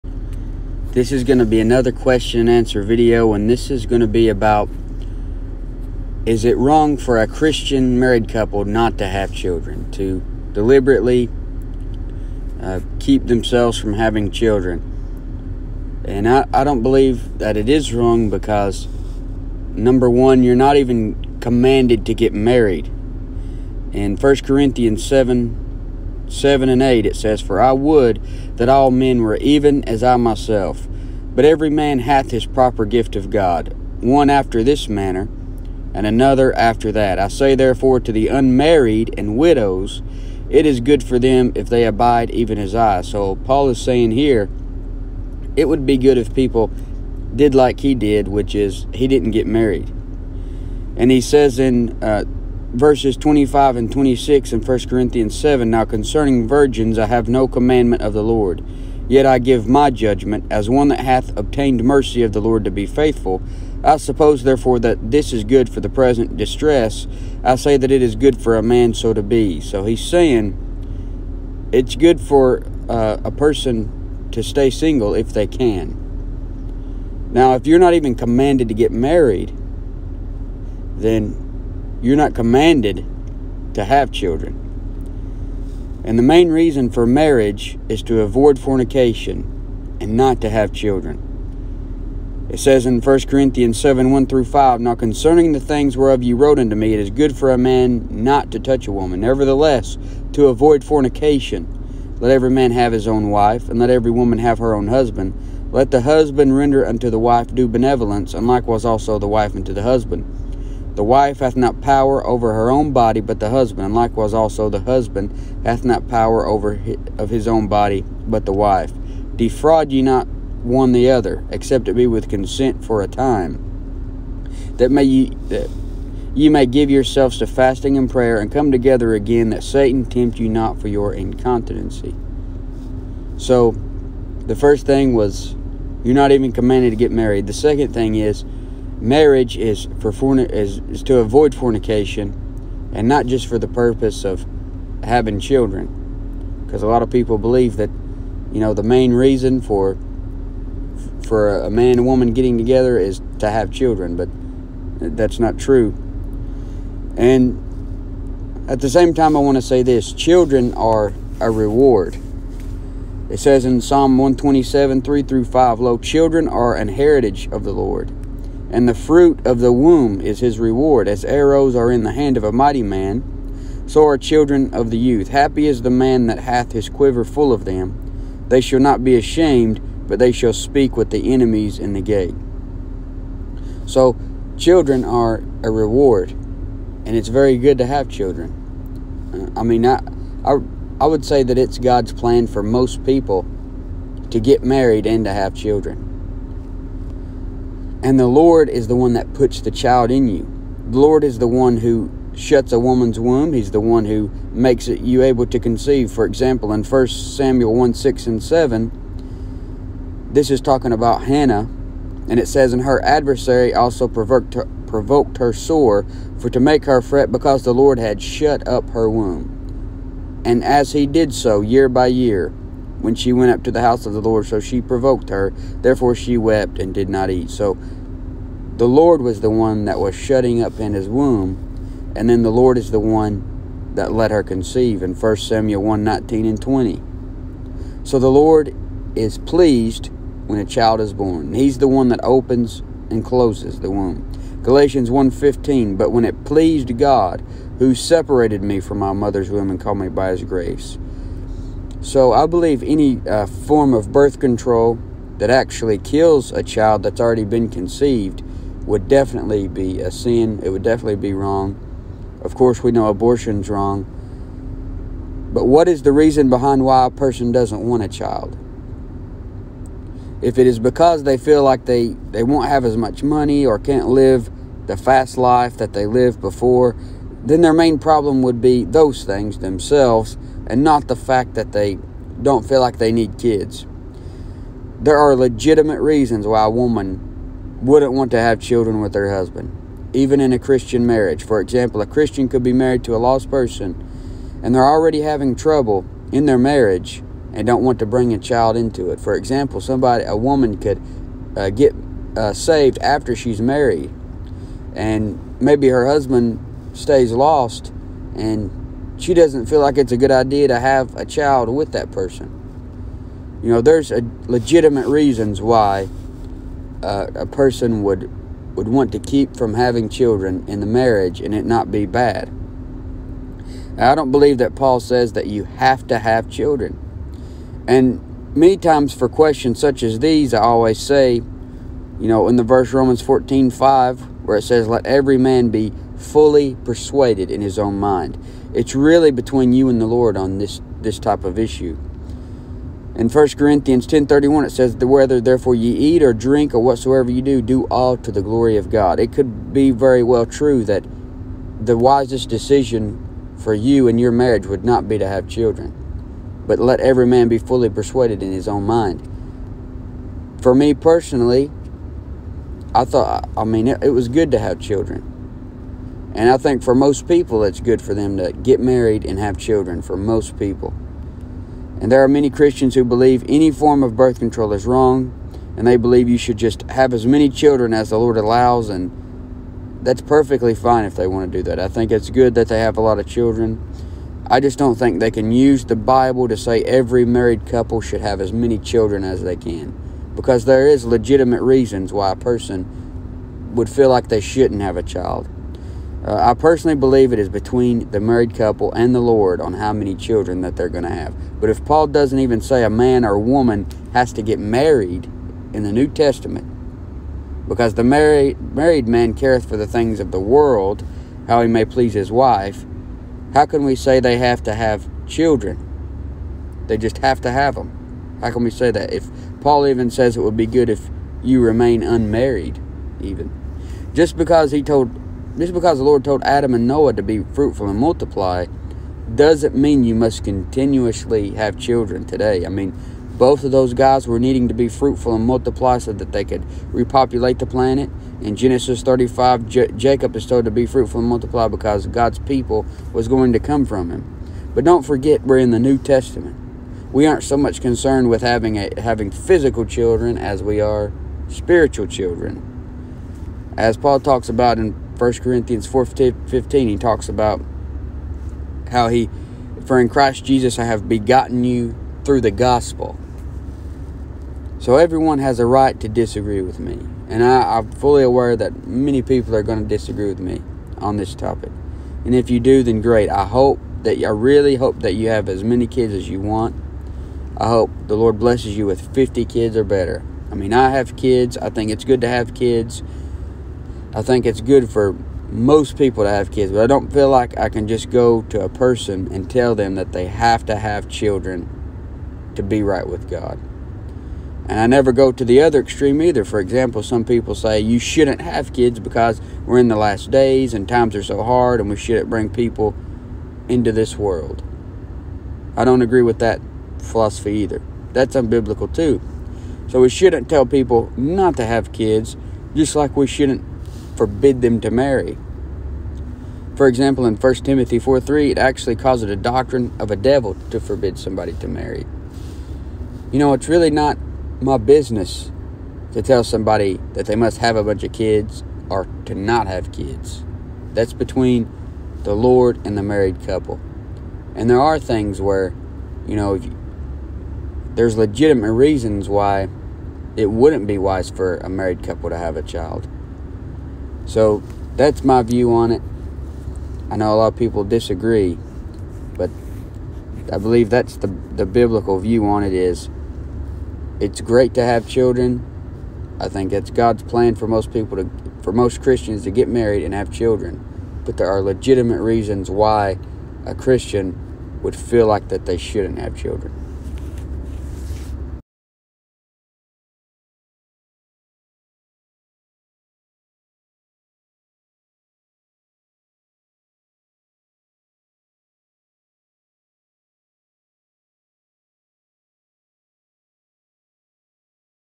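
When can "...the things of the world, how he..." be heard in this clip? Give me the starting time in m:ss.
6:49.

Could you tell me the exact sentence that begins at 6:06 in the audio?
And I think for most people, it's good for them to get married and have children, for most people.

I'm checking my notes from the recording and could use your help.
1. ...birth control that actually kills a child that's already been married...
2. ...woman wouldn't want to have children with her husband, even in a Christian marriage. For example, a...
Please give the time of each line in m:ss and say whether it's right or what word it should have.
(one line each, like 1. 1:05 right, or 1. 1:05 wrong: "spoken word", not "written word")
1. 4:14 wrong: "conceived", not "married"
2. 4:46 right.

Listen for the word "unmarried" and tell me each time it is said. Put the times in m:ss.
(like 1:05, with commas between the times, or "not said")
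0:38, 7:02.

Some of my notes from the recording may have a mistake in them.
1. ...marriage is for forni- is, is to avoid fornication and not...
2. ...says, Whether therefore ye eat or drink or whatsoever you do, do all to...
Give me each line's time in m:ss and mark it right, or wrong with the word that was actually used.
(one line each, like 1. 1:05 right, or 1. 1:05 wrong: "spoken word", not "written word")
1. 2:19 right
2. 5:44 right.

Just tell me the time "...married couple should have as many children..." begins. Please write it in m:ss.
6:27.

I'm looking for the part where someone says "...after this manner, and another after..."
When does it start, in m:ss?
0:34.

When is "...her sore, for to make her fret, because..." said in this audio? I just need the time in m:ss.
3:35.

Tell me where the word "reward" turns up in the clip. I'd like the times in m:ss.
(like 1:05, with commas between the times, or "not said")
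2:41, 2:50, 3:05.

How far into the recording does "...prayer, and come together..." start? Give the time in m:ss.
2:08.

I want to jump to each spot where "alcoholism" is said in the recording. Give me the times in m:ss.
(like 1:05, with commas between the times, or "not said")
not said.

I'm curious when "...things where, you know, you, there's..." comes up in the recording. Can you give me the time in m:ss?
8:54.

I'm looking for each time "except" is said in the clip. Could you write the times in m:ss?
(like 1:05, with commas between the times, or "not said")
2:01.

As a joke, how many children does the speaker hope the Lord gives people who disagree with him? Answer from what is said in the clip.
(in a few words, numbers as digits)
50.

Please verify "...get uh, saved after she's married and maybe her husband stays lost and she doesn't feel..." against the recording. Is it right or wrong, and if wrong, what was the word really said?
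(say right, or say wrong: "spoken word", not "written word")
right.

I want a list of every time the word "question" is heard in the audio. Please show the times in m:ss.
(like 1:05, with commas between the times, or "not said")
0:01, 5:29.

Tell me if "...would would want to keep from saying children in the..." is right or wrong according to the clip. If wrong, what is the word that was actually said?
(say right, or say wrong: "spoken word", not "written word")
wrong: "having", not "saying".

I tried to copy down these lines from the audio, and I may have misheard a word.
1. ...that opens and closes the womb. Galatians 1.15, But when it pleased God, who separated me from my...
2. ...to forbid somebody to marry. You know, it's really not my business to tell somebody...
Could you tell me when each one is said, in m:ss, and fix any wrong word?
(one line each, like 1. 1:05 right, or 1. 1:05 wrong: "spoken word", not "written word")
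1. 4:02 right
2. 8:40 right.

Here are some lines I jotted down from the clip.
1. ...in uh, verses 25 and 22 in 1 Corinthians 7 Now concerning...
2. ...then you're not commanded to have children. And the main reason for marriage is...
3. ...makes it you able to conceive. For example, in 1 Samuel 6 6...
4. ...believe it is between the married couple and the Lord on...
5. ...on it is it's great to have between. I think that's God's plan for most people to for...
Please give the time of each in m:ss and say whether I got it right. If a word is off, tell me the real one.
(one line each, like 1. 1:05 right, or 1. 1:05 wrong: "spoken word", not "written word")
1. 0:51 wrong: "26", not "22"
2. 1:20 right
3. 3:24 wrong: "1", not "6"
4. 6:36 right
5. 9:12 wrong: "children", not "between".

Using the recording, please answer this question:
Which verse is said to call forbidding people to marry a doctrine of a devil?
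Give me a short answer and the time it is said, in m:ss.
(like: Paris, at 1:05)
1 Timothy 4:3, at 8:37.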